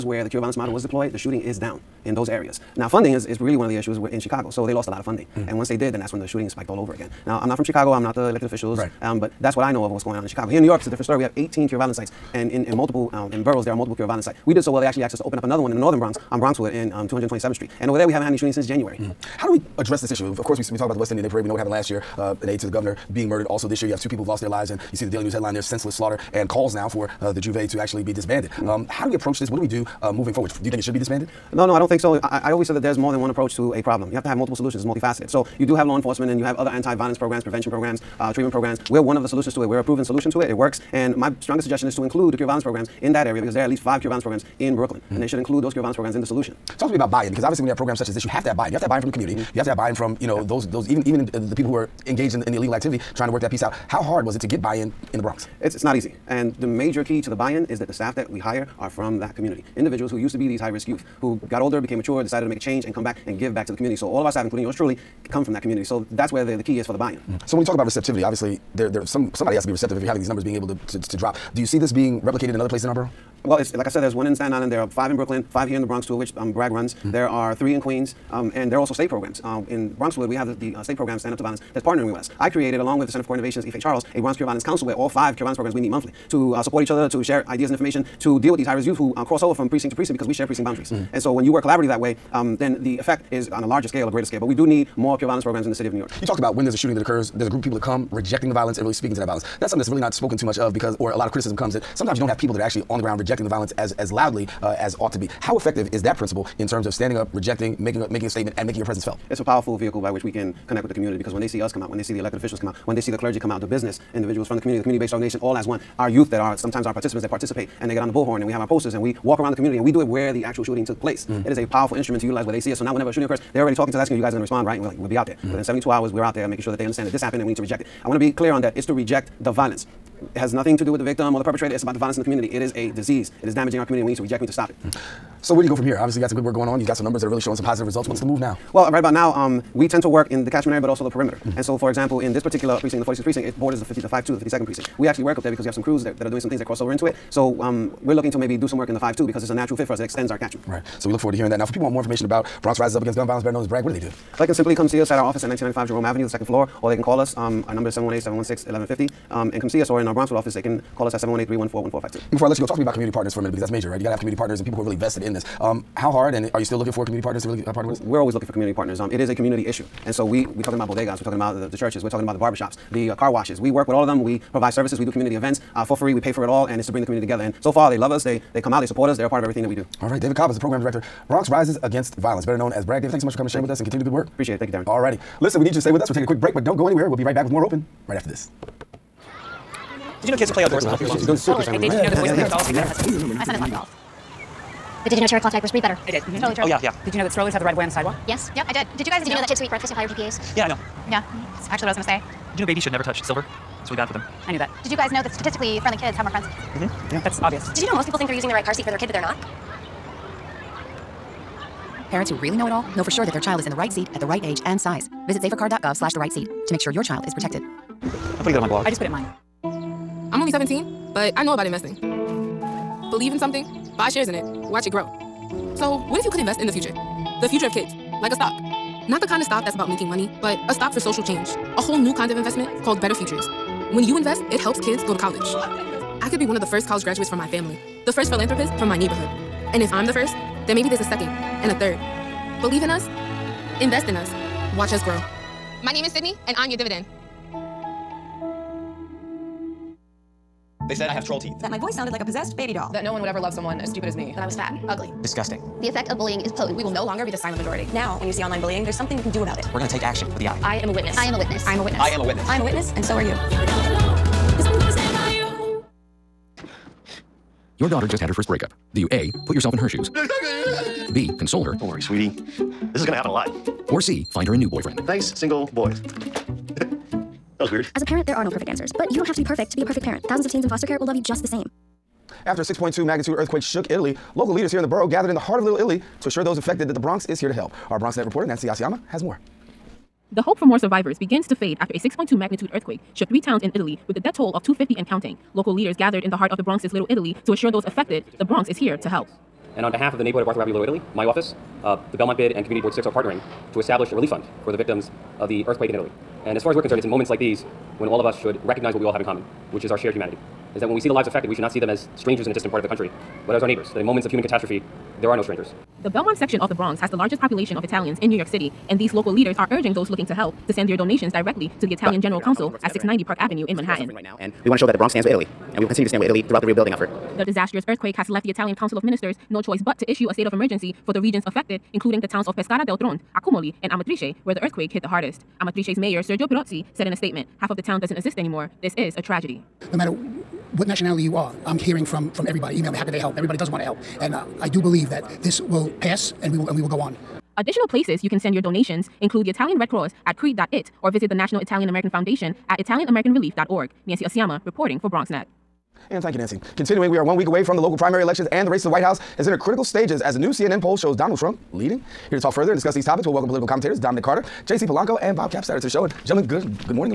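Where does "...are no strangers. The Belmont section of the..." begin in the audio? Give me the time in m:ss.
5:15.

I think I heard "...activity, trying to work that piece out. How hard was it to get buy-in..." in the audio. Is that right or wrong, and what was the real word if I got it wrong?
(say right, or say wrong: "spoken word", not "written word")
right.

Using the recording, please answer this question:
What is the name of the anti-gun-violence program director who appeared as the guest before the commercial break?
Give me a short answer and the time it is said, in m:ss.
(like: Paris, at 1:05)
David Caba, at 3:00.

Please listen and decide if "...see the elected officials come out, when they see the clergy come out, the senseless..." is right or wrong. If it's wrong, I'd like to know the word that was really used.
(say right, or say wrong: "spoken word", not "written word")
wrong: "business", not "senseless".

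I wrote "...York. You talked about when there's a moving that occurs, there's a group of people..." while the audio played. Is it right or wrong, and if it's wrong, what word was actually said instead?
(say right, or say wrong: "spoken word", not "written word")
wrong: "shooting", not "moving".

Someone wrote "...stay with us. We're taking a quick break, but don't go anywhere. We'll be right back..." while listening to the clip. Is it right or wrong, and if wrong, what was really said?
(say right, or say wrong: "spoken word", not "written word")
right.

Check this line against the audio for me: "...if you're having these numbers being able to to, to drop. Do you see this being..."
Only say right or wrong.
right.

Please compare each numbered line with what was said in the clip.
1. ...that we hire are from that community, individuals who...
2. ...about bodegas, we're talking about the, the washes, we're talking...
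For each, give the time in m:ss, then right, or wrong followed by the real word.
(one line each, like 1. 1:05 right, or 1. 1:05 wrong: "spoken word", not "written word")
1. 0:58 right
2. 2:50 wrong: "churches", not "washes".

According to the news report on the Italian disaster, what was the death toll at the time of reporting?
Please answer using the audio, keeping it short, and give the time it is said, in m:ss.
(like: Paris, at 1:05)
250, at 4:54.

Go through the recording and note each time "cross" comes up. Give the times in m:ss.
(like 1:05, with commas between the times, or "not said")
1:29, 2:26, 5:49.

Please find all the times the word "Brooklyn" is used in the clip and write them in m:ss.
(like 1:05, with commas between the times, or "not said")
0:44, 1:15.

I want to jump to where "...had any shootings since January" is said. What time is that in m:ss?
0:18.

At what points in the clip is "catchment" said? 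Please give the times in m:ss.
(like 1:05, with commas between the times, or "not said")
2:20, 2:30.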